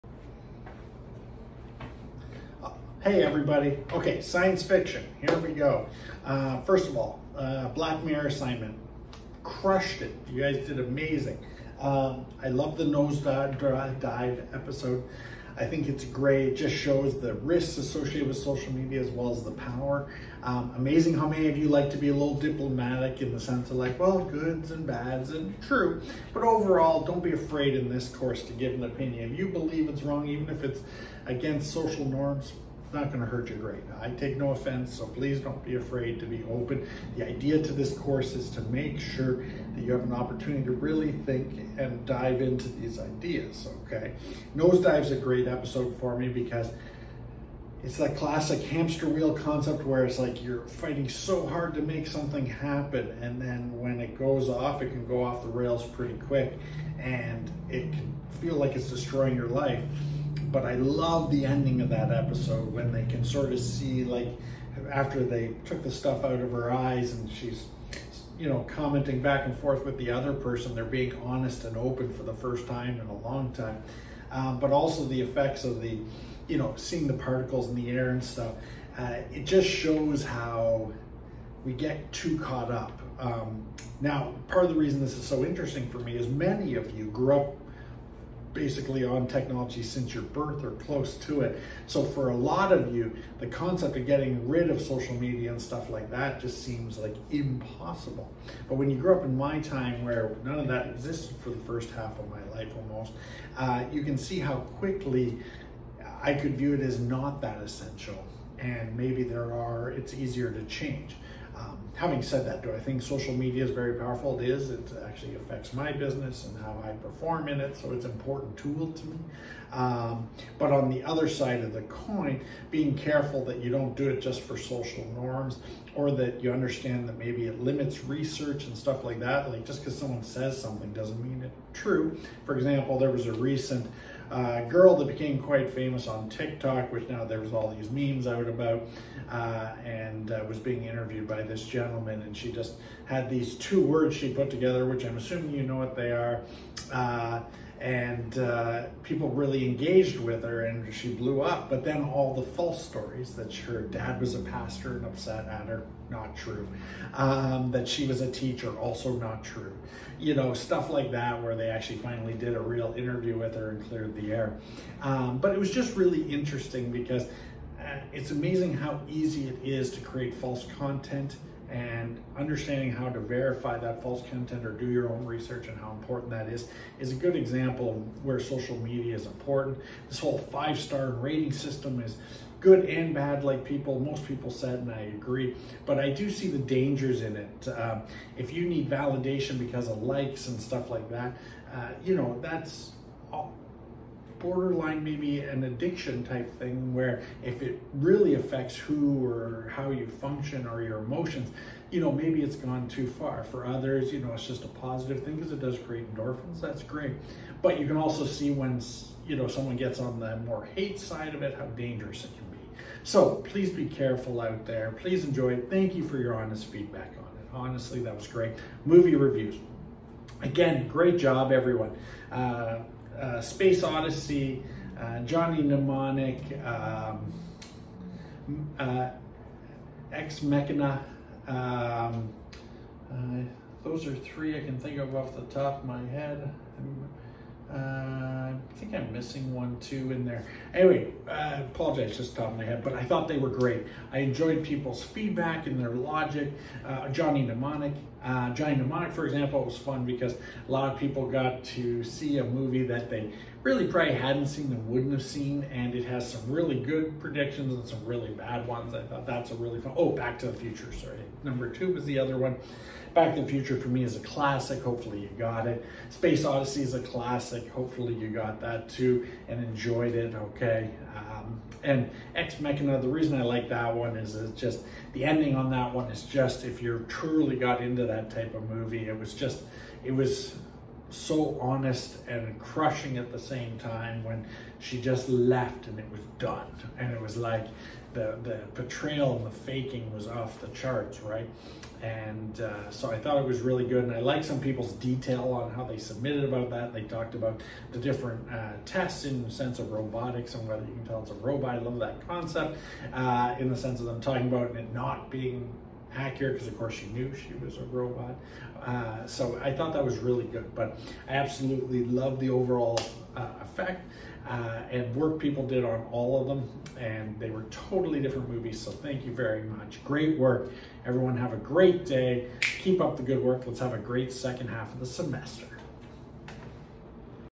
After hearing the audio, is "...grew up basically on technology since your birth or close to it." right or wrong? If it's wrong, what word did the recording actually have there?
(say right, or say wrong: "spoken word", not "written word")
right.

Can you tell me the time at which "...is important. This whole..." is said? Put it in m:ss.
2:59.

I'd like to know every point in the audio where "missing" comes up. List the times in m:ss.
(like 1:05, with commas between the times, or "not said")
3:59.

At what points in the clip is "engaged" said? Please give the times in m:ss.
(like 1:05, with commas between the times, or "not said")
2:29.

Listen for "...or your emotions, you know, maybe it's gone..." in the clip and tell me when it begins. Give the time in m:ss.
3:20.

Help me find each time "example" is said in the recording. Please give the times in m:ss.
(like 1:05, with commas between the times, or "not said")
2:12, 2:57, 4:09.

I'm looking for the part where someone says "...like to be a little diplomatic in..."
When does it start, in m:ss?
0:21.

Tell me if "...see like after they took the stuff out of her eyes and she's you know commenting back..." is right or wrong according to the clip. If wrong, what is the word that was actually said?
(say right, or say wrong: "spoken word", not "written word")
right.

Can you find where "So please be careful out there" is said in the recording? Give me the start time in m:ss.
3:33.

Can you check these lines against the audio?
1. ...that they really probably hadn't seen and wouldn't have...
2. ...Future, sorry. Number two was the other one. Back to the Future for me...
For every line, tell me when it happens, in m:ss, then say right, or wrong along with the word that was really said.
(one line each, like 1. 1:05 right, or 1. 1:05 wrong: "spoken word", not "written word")
1. 4:12 right
2. 4:20 right.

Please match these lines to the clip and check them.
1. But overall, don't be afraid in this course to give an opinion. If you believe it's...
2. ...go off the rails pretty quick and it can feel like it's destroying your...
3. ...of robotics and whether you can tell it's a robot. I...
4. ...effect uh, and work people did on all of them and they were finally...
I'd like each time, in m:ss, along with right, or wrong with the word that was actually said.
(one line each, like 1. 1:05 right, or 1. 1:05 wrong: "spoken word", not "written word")
1. 0:26 right
2. 0:55 right
3. 4:59 right
4. 5:13 wrong: "totally", not "finally".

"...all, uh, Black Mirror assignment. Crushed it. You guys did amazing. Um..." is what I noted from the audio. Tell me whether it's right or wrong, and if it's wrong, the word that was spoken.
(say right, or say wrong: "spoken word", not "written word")
right.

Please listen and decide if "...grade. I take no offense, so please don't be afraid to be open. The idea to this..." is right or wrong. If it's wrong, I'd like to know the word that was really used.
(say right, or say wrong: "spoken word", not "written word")
right.